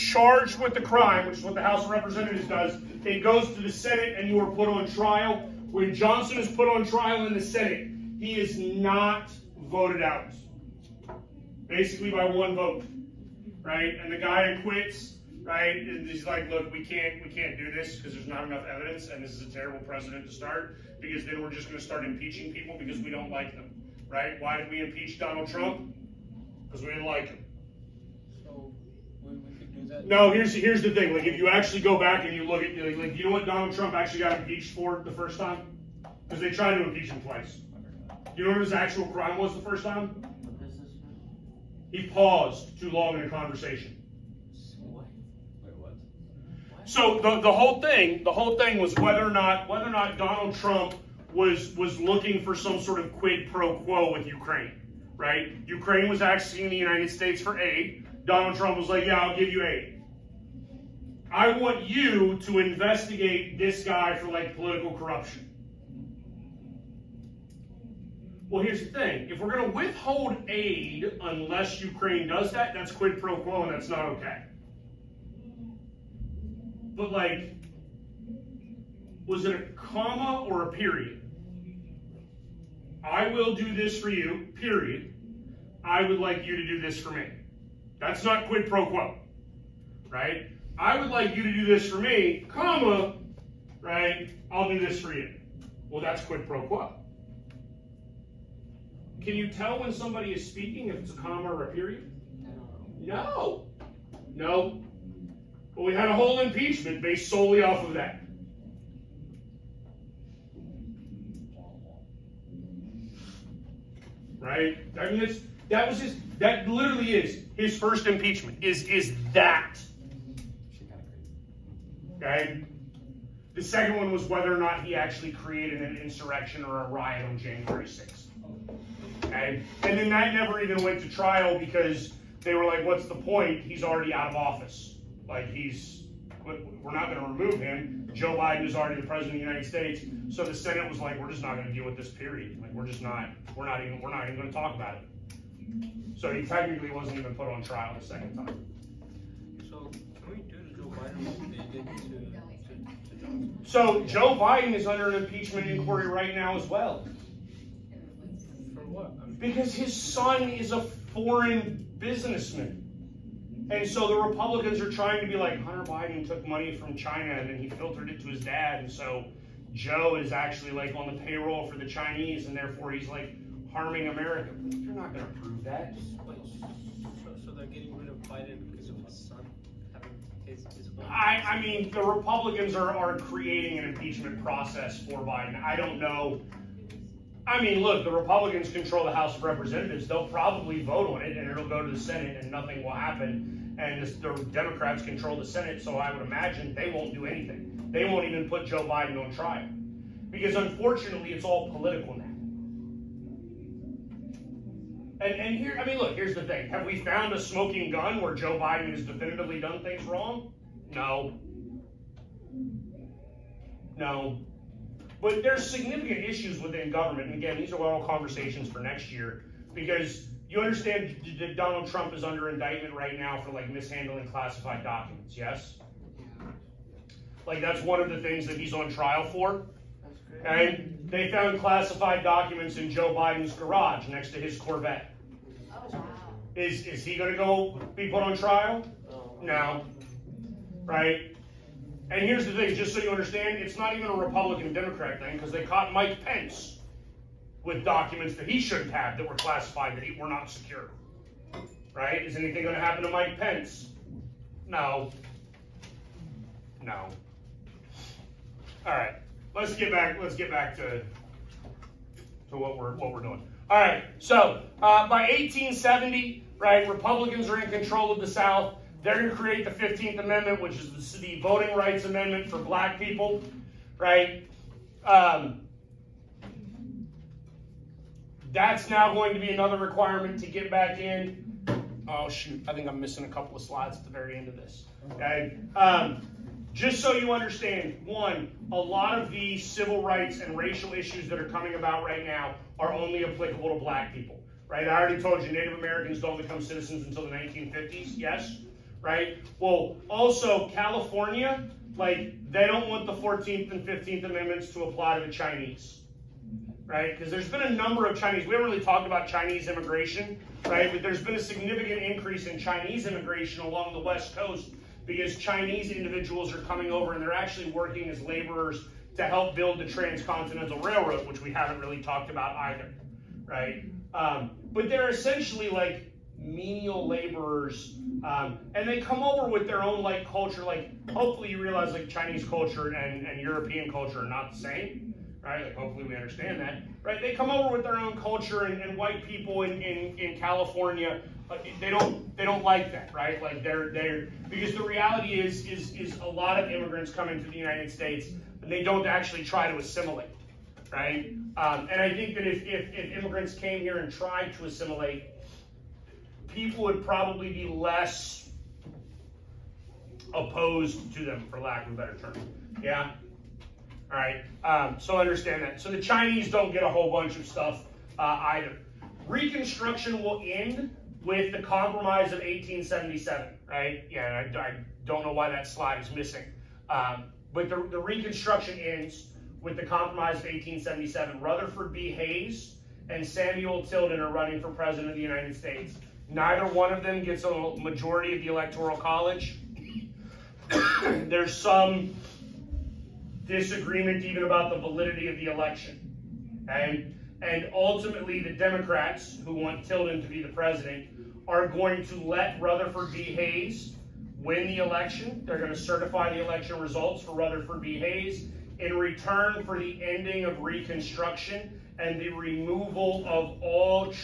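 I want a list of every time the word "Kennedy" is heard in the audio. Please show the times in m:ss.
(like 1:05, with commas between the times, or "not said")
not said.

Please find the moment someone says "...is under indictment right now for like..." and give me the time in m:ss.
3:42.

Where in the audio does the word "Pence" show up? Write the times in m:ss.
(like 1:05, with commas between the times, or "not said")
4:06, 4:13.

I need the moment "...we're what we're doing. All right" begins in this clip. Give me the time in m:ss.
4:22.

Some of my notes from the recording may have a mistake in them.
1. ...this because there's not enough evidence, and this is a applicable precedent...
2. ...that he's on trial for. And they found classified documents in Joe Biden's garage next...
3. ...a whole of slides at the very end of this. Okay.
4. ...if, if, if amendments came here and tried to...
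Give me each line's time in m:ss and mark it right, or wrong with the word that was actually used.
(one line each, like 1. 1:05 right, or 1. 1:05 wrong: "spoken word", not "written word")
1. 0:17 wrong: "terrible", not "applicable"
2. 3:48 right
3. 4:43 wrong: "couple", not "whole"
4. 5:52 wrong: "immigrants", not "amendments".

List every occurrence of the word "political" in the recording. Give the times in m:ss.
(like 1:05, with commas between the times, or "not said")
1:04, 3:21.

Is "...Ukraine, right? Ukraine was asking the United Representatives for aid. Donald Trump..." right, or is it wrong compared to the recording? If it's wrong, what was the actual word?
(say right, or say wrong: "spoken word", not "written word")
wrong: "States", not "Representatives".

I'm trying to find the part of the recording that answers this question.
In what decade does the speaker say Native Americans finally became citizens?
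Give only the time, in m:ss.
4:57.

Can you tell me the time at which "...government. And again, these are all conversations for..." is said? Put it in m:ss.
3:36.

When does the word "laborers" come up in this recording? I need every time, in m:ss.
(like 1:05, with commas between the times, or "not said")
5:18, 5:27.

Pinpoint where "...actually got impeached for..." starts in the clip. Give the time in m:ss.
0:33.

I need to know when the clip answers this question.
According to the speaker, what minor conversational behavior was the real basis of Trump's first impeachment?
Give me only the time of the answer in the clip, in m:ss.
0:41.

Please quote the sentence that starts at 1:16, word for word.
But, like, was it a comma or a period?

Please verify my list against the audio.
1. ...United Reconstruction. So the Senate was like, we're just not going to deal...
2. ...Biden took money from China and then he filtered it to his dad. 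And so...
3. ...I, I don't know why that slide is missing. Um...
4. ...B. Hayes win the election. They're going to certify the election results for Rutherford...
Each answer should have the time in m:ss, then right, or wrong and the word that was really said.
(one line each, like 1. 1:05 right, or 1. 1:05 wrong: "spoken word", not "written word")
1. 2:19 wrong: "States", not "Reconstruction"
2. 2:45 right
3. 6:14 right
4. 6:43 right.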